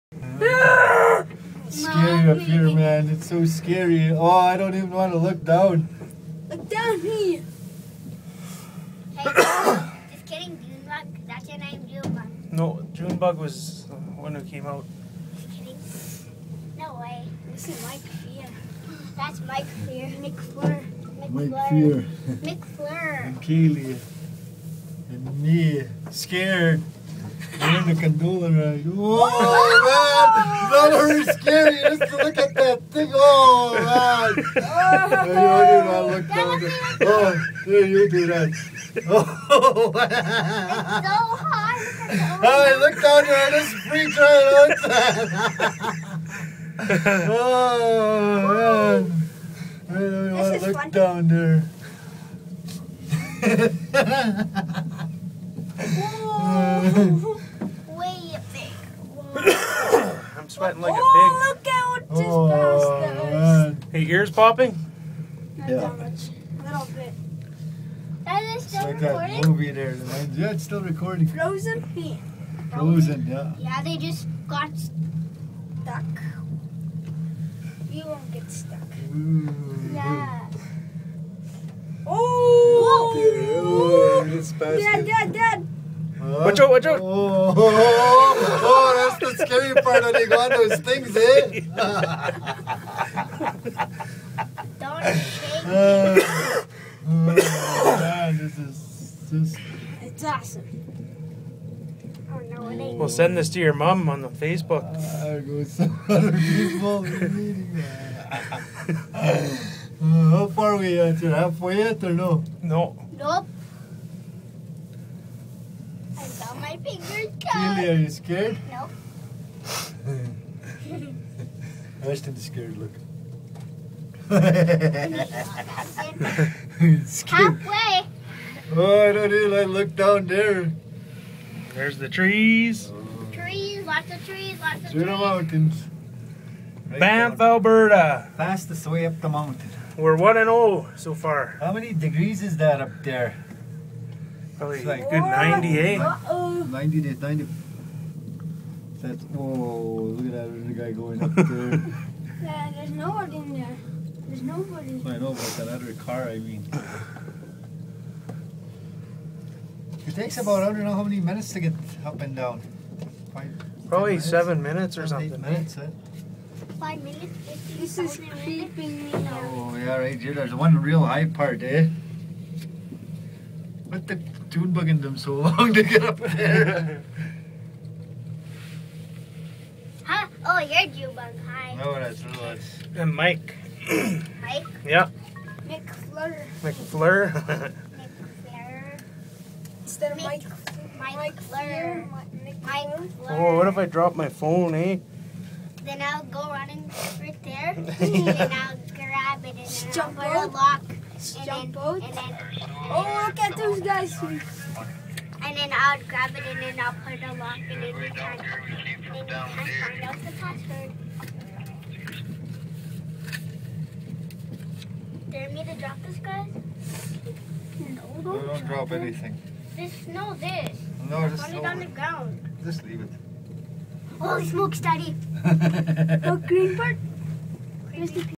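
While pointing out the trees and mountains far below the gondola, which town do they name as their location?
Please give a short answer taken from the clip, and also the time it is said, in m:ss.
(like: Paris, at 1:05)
Banff, at 2:16.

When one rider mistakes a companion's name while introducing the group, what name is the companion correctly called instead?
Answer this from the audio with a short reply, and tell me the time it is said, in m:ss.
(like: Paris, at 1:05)
Lewis, at 3:02.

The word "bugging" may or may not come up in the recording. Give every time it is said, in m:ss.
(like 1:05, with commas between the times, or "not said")
2:54.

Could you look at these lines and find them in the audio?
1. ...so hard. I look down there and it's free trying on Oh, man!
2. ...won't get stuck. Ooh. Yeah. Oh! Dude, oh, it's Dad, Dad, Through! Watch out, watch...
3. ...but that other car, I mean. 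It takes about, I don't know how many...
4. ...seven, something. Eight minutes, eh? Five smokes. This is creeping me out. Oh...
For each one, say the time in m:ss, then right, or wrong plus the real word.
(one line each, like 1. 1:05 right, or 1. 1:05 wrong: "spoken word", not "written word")
1. 0:41 right
2. 1:18 wrong: "Dad", not "Through"
3. 2:35 right
4. 2:45 wrong: "minutes", not "smokes".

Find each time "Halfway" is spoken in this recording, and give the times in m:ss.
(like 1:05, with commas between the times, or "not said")
1:51, 2:05.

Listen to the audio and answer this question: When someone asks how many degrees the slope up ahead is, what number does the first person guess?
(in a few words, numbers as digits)
98.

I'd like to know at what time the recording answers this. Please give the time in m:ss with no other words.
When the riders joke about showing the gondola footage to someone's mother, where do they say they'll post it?
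1:44.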